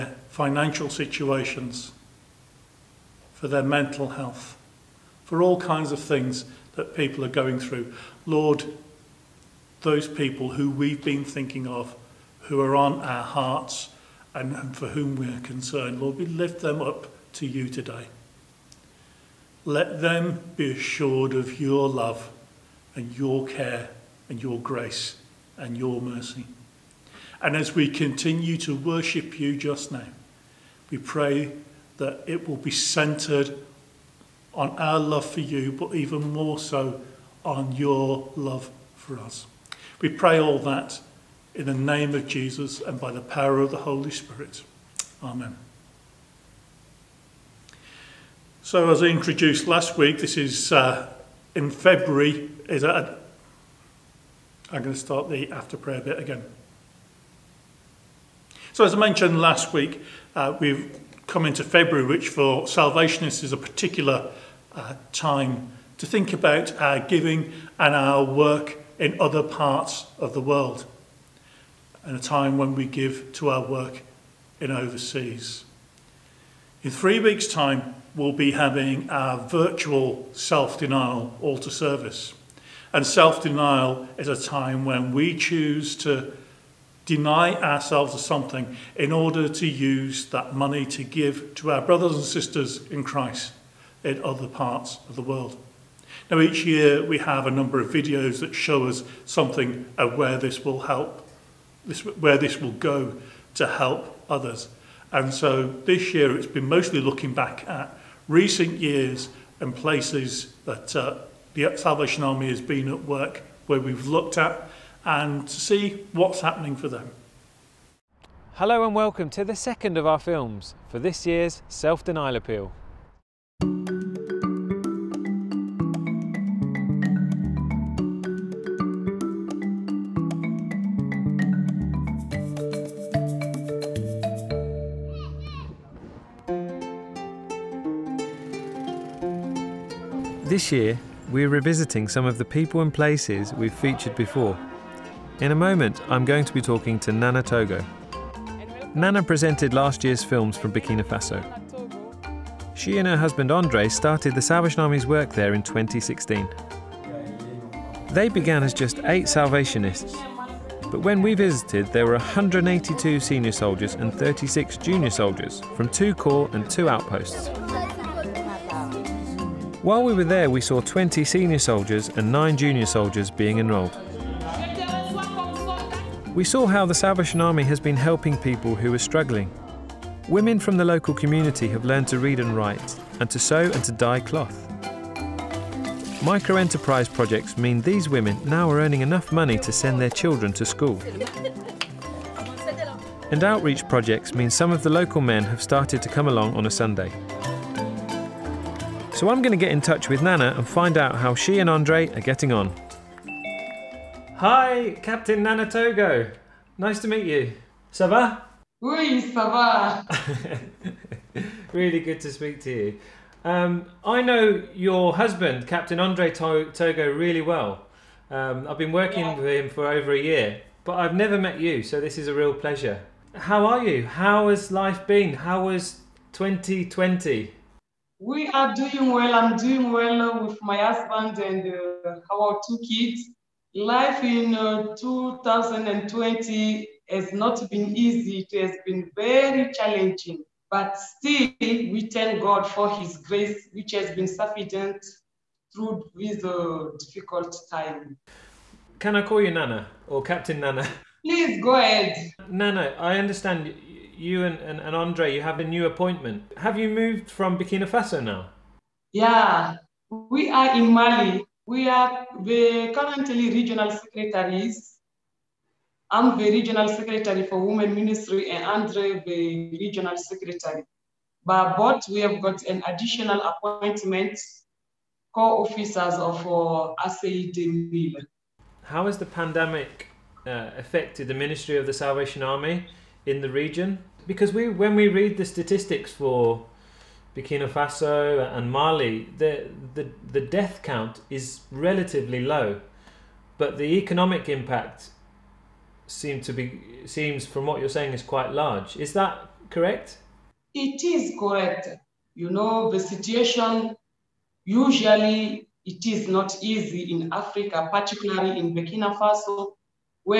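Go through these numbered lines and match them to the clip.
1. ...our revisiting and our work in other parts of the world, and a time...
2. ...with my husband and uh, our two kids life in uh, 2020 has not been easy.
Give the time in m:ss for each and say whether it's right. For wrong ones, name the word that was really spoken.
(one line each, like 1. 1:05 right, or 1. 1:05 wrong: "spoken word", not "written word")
1. 1:06 wrong: "giving", not "revisiting"
2. 3:50 right.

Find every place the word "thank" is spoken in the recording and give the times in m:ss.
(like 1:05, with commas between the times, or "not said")
4:02.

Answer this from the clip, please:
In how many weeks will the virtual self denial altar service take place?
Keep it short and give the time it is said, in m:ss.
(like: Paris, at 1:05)
3, at 1:16.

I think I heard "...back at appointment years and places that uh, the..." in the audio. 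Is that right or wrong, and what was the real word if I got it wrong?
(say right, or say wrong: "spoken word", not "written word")
wrong: "recent", not "appointment".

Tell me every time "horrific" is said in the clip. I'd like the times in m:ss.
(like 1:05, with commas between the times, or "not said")
not said.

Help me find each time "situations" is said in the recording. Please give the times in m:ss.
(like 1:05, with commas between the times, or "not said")
0:00, 5:02.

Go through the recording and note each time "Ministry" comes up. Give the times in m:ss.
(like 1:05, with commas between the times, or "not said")
4:27, 4:41.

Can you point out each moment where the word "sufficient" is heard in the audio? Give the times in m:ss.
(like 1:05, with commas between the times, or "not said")
4:04.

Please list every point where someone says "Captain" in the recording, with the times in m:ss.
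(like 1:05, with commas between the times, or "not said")
3:25, 3:35, 4:10.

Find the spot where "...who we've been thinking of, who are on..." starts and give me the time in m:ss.
0:10.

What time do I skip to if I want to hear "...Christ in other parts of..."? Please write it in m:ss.
1:33.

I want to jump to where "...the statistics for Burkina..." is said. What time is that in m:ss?
4:45.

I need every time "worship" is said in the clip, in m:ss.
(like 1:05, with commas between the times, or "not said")
0:28.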